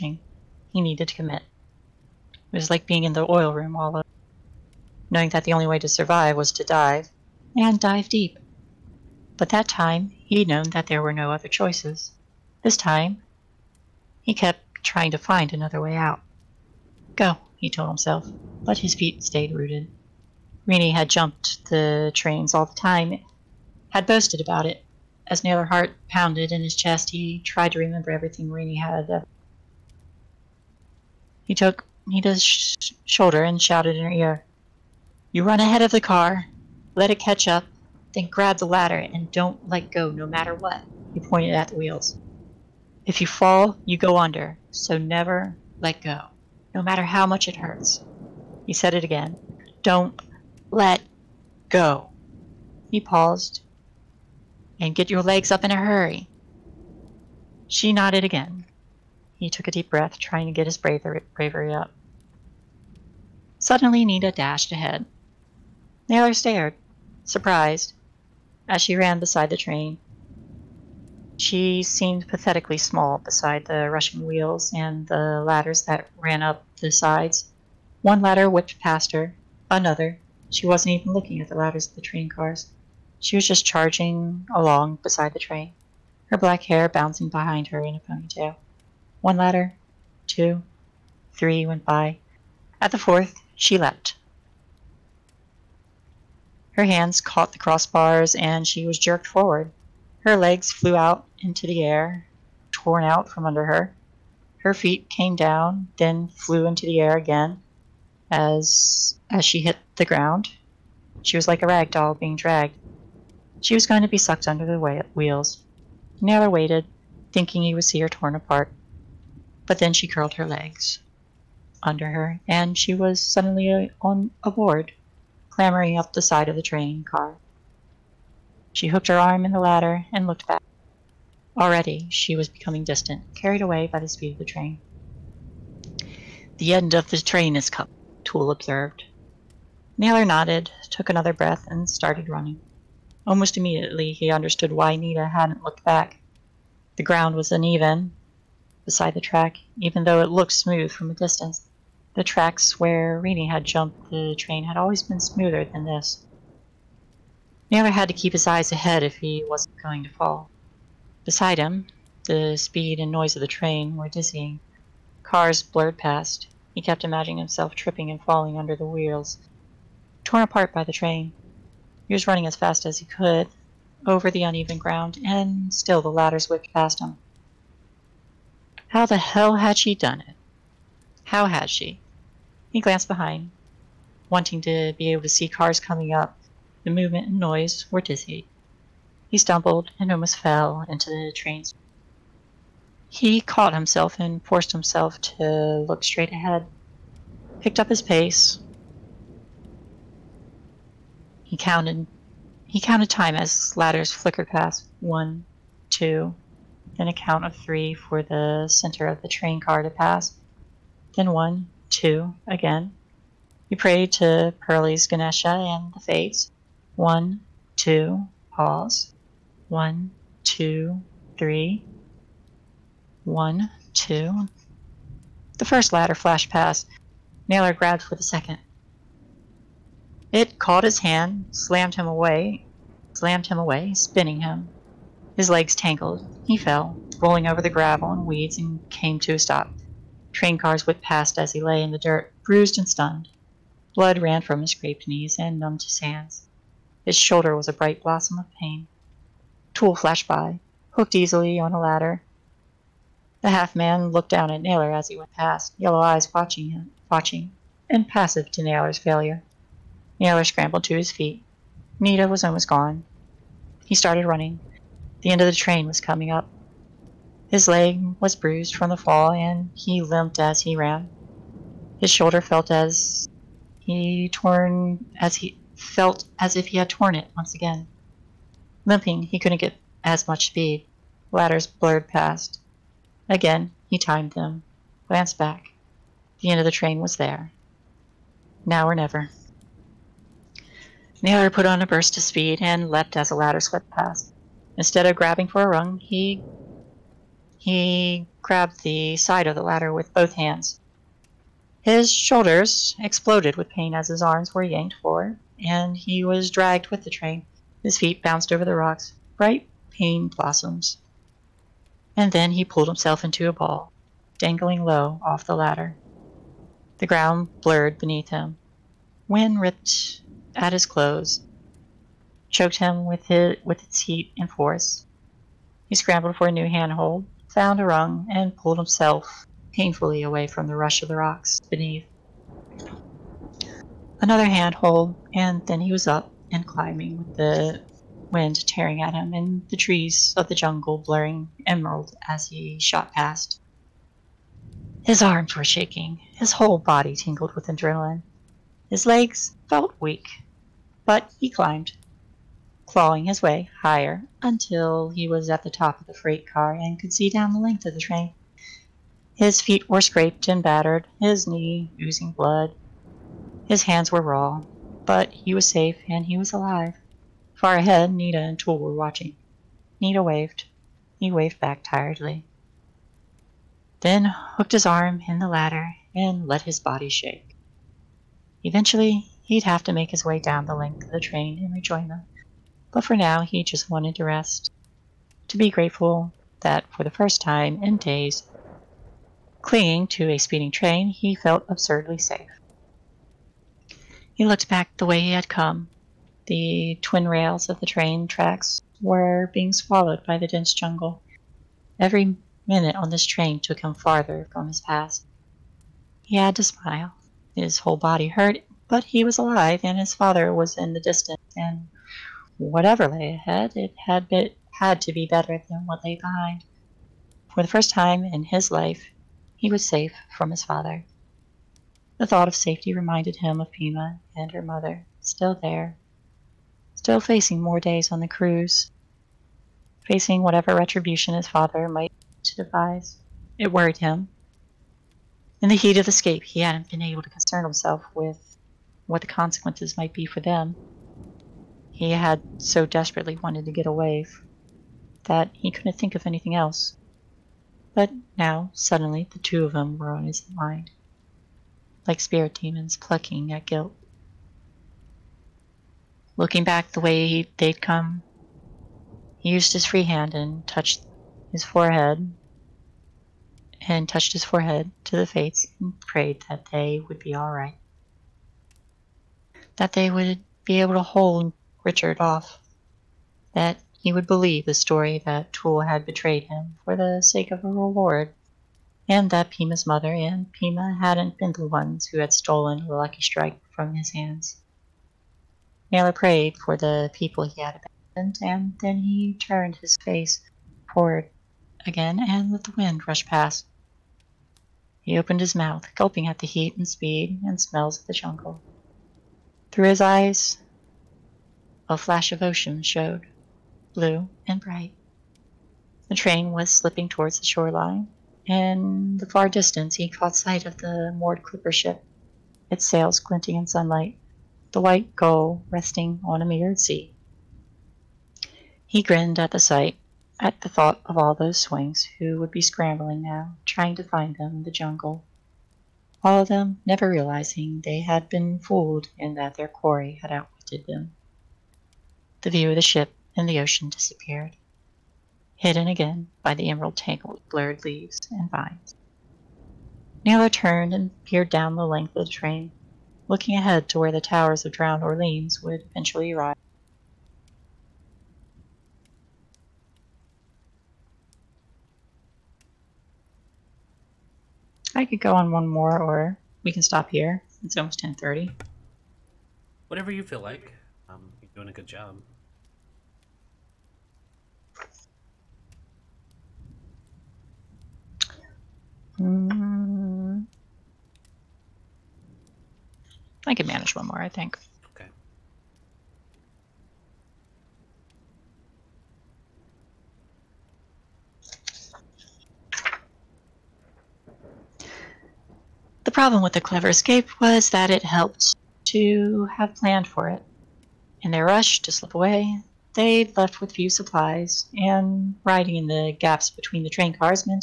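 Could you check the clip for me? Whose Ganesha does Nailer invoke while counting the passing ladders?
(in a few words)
Pearlie's.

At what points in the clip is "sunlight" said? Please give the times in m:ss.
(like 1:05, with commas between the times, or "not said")
8:33.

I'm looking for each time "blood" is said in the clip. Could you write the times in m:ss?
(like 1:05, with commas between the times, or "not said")
4:03, 6:02.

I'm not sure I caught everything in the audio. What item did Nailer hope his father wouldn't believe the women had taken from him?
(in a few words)
The Lucky Strike.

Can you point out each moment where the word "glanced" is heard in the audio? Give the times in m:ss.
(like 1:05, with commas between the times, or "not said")
3:02, 4:45.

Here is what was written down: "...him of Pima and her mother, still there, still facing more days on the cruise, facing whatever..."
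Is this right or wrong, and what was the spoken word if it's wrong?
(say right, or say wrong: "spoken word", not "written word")
right.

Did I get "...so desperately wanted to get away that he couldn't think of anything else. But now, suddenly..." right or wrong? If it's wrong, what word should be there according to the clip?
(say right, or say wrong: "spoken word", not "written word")
right.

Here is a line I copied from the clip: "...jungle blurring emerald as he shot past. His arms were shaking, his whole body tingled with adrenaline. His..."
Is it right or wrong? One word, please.
right.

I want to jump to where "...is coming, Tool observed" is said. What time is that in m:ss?
2:17.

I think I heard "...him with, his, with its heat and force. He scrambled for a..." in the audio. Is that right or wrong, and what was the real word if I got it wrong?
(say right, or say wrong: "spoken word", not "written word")
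right.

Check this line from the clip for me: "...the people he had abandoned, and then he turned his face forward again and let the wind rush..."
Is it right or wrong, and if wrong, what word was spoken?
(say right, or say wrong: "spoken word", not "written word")
right.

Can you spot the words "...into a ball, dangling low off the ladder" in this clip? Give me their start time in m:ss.
5:13.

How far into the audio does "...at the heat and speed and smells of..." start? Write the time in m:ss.
8:16.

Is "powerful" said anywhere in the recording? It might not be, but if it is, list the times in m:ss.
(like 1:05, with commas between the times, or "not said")
not said.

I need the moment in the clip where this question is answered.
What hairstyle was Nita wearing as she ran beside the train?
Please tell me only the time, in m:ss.
1:27.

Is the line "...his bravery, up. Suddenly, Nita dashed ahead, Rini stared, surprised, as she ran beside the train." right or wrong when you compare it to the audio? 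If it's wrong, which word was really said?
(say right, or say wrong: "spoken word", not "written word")
wrong: "Nailer", not "Rini".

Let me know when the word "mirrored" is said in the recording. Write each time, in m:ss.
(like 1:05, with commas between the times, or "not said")
8:36.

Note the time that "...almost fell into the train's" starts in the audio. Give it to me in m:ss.
3:10.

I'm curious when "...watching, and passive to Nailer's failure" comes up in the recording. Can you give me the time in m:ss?
4:17.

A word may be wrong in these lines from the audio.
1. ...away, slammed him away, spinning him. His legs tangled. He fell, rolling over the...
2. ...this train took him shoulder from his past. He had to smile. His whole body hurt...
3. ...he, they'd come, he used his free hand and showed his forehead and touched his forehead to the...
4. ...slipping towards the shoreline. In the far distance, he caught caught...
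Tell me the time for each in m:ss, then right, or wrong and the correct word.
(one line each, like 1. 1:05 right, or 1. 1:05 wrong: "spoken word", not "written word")
1. 3:52 right
2. 6:43 wrong: "farther", not "shoulder"
3. 7:37 wrong: "touched", not "showed"
4. 8:26 wrong: "sight", not "caught".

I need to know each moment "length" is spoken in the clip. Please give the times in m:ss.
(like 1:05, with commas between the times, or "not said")
5:57, 6:20, 9:01.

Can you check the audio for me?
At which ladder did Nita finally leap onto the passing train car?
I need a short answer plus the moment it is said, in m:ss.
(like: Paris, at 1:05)
The fourth, at 1:32.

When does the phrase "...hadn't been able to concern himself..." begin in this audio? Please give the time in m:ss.
7:16.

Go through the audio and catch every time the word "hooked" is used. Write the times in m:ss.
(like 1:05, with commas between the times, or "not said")
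2:08, 4:10, 6:14.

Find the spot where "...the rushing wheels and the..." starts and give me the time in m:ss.
1:13.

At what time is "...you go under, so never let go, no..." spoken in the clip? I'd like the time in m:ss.
0:43.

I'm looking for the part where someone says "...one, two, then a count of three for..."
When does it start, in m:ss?
3:24.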